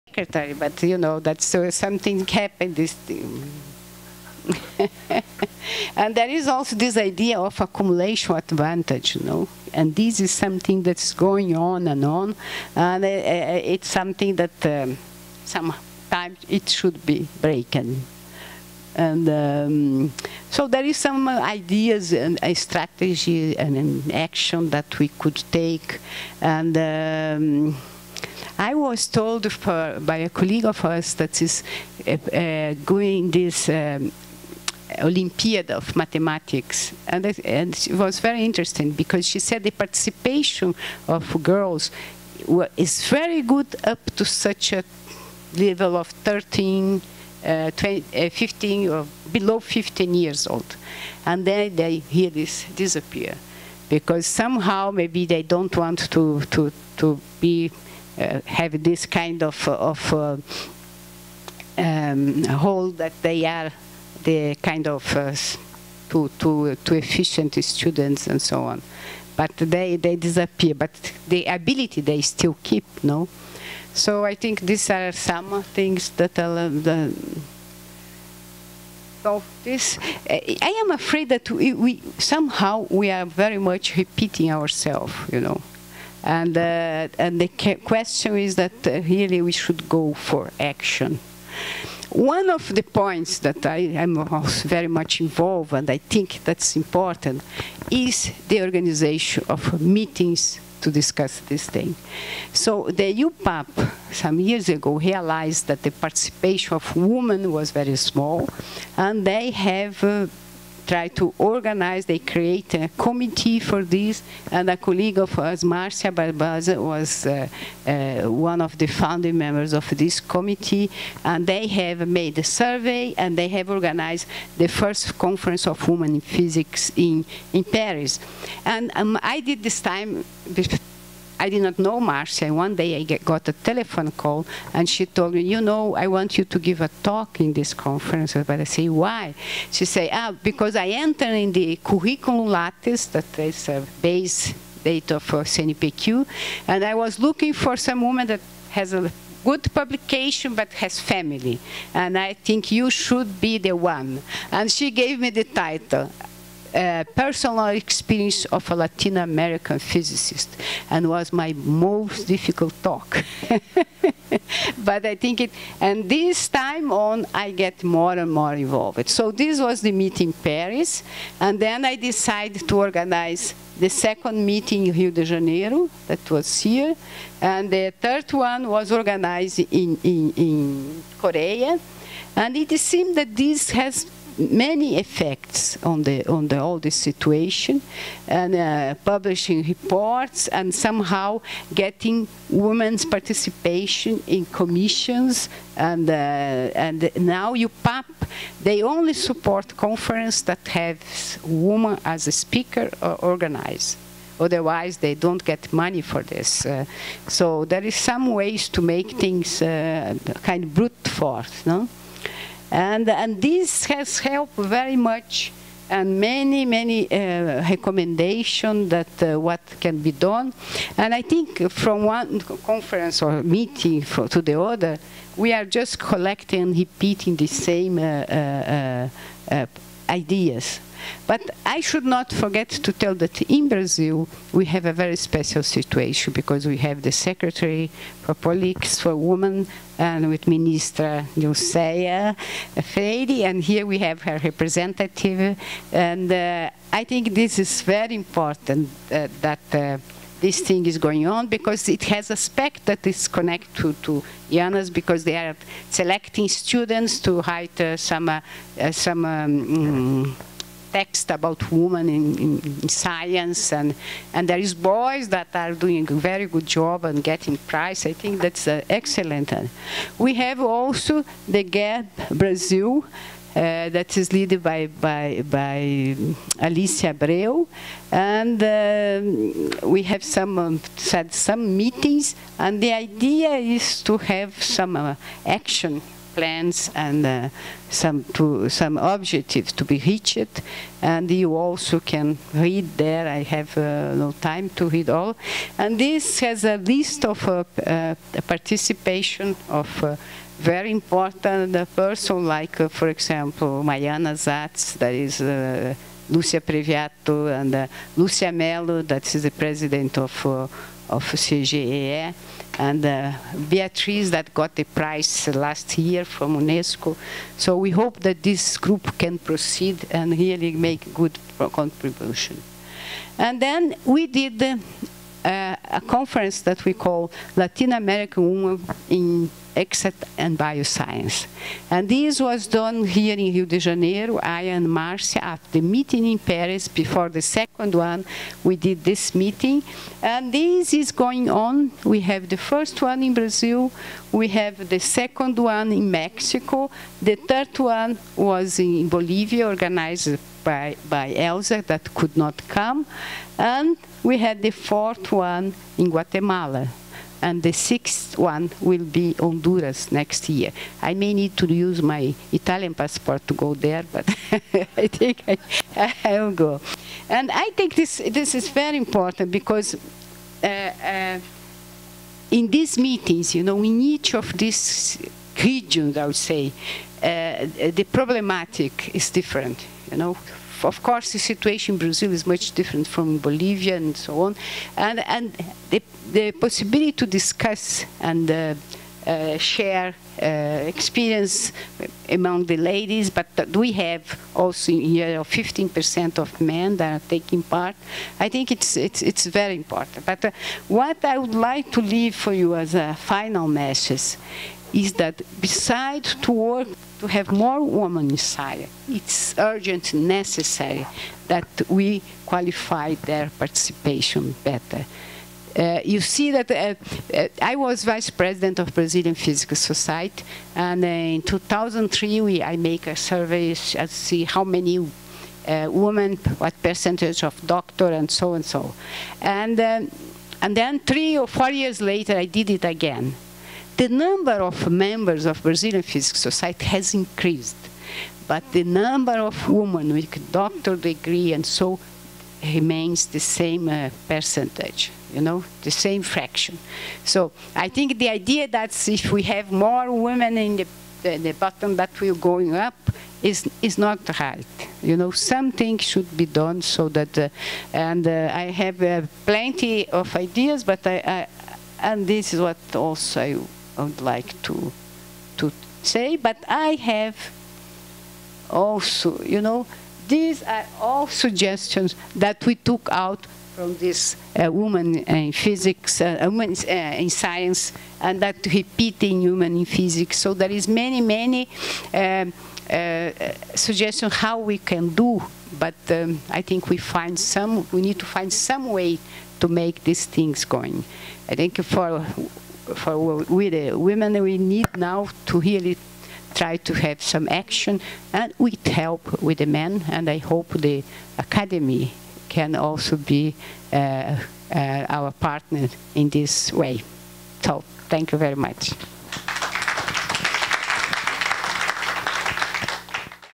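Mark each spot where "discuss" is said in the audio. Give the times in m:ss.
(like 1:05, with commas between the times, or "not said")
1:40, 6:27.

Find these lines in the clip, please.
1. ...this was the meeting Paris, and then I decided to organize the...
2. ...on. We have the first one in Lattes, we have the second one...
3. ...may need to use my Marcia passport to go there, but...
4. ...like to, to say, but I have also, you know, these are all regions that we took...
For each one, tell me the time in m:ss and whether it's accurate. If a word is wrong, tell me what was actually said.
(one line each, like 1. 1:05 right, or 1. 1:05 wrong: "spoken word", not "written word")
1. 2:49 right
2. 5:41 wrong: "Brazil", not "Lattes"
3. 6:01 wrong: "Italian", not "Marcia"
4. 7:44 wrong: "suggestions", not "regions".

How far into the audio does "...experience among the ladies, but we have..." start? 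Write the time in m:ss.
6:30.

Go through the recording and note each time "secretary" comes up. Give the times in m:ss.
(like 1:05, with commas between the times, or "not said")
0:00, 3:57.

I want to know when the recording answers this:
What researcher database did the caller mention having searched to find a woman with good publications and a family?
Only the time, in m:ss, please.
2:21.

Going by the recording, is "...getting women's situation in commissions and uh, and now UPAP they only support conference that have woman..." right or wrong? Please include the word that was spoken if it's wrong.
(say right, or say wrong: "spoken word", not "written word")
wrong: "participation", not "situation".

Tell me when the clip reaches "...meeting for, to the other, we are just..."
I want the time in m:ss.
3:43.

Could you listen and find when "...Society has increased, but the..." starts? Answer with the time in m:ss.
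7:16.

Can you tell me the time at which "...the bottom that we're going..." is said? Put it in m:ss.
7:31.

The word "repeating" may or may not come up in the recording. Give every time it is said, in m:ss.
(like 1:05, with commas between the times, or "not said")
1:23, 3:46, 7:58.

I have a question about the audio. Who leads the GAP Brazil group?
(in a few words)
Alice Abreu.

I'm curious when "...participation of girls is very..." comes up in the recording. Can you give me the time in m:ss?
0:39.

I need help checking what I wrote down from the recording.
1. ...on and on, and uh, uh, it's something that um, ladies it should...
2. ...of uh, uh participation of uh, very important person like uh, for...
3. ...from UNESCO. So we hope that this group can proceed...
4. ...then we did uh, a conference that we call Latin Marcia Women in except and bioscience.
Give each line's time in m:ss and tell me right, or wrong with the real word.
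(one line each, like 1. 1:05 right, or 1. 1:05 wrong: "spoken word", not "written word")
1. 0:11 wrong: "sometimes", not "ladies"
2. 4:57 right
3. 5:16 right
4. 5:23 wrong: "American", not "Marcia".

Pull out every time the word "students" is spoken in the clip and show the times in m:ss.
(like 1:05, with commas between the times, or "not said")
1:07, 4:16.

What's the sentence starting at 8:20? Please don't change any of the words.
And I hope the academy can also be uh, uh, our partner in this way.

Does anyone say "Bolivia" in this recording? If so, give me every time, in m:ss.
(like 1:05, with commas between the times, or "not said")
5:49, 6:23.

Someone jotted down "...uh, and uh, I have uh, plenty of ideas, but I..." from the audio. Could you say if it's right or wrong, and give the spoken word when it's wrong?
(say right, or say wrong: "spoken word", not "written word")
right.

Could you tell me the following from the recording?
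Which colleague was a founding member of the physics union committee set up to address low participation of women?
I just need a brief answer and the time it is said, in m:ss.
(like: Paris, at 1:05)
Marcia Barbosa, at 1:55.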